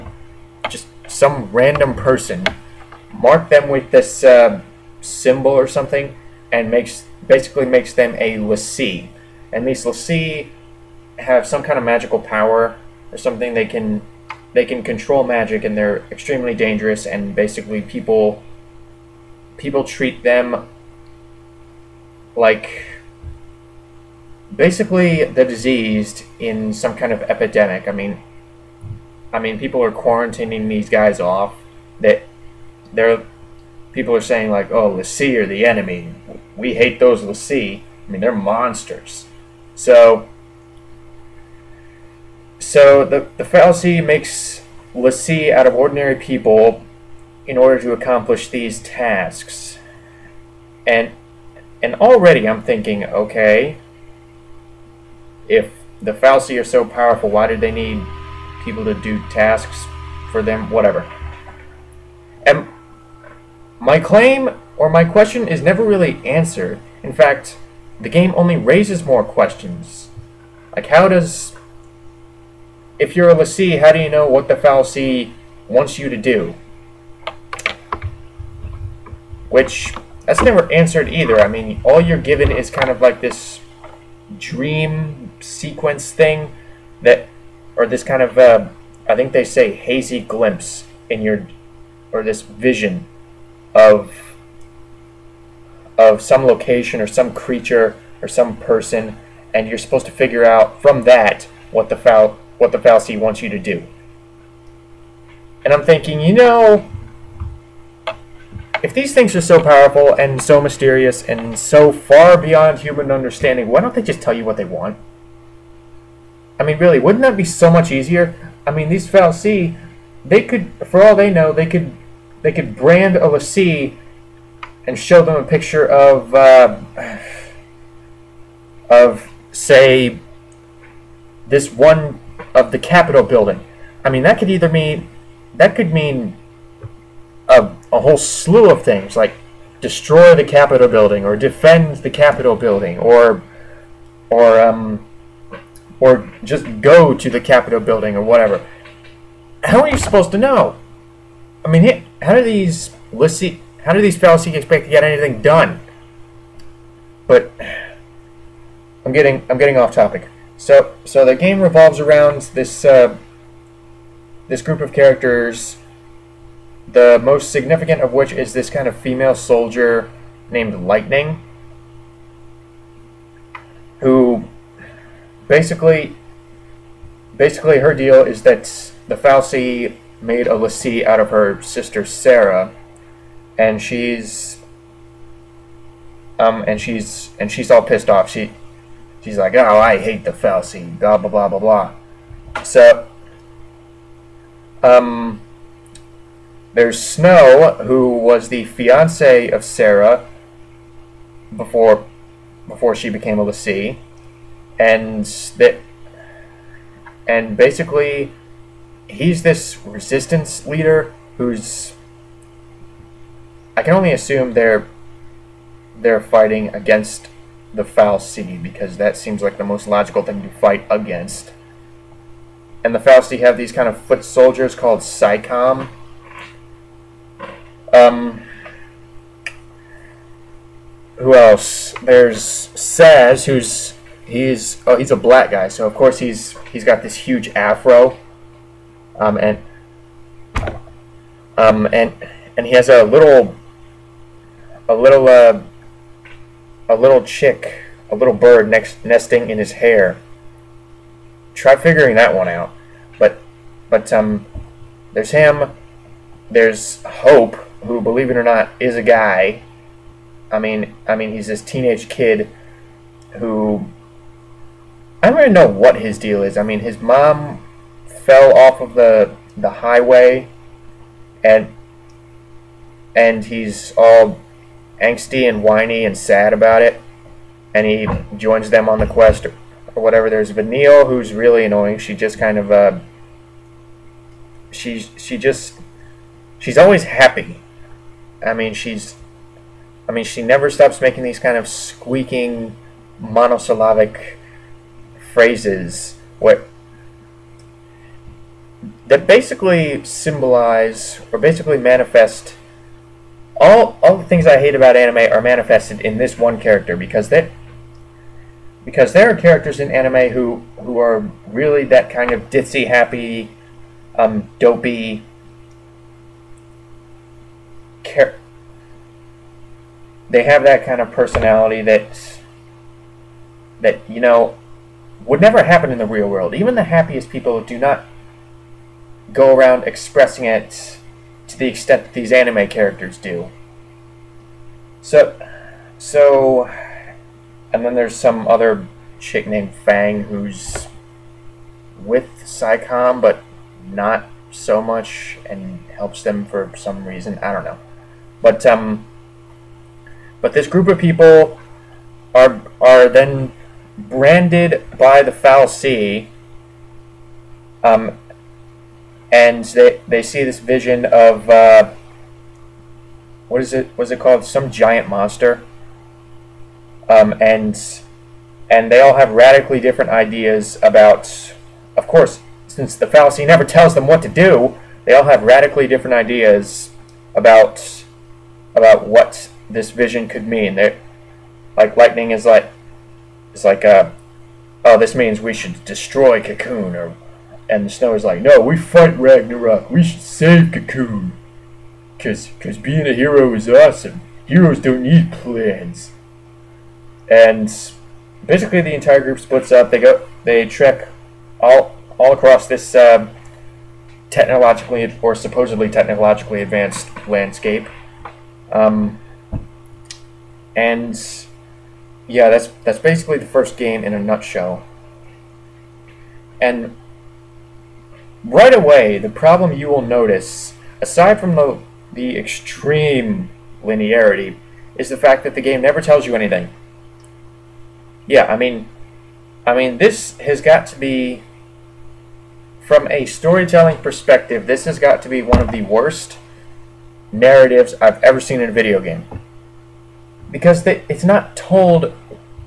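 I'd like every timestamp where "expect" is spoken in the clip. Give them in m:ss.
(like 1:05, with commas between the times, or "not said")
2:34.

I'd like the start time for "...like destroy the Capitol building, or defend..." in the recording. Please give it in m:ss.
2:19.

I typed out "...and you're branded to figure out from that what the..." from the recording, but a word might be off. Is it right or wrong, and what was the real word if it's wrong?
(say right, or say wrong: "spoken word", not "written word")
wrong: "supposed", not "branded".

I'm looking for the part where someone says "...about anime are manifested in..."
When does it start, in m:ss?
5:04.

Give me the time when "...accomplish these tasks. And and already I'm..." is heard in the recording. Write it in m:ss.
0:47.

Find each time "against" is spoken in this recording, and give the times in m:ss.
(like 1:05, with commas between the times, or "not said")
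3:36, 3:40.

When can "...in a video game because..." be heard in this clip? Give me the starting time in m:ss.
7:18.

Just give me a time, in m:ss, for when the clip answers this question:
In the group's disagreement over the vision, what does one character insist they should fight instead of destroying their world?
6:29.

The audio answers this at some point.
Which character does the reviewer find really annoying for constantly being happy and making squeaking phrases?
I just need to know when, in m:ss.
4:40.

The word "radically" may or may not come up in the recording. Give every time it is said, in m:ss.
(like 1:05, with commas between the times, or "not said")
6:09, 6:15.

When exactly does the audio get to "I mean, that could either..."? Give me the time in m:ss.
2:14.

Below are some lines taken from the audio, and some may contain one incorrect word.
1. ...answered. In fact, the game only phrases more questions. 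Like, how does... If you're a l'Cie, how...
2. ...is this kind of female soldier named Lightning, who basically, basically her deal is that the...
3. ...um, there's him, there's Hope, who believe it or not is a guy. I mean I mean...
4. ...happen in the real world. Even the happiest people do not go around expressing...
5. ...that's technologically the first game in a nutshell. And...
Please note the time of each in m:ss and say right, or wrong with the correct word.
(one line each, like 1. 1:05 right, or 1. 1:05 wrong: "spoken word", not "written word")
1. 1:06 wrong: "raises", not "phrases"
2. 2:48 right
3. 4:14 right
4. 5:25 right
5. 6:52 wrong: "basically", not "technologically".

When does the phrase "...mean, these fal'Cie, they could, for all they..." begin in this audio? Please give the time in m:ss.
1:58.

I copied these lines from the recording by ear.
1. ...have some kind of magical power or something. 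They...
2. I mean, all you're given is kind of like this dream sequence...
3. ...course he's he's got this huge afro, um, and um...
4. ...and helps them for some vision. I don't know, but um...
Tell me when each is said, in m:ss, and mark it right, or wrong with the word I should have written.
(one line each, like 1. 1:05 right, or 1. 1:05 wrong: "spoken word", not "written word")
1. 0:11 right
2. 1:21 right
3. 3:55 right
4. 5:45 wrong: "reason", not "vision".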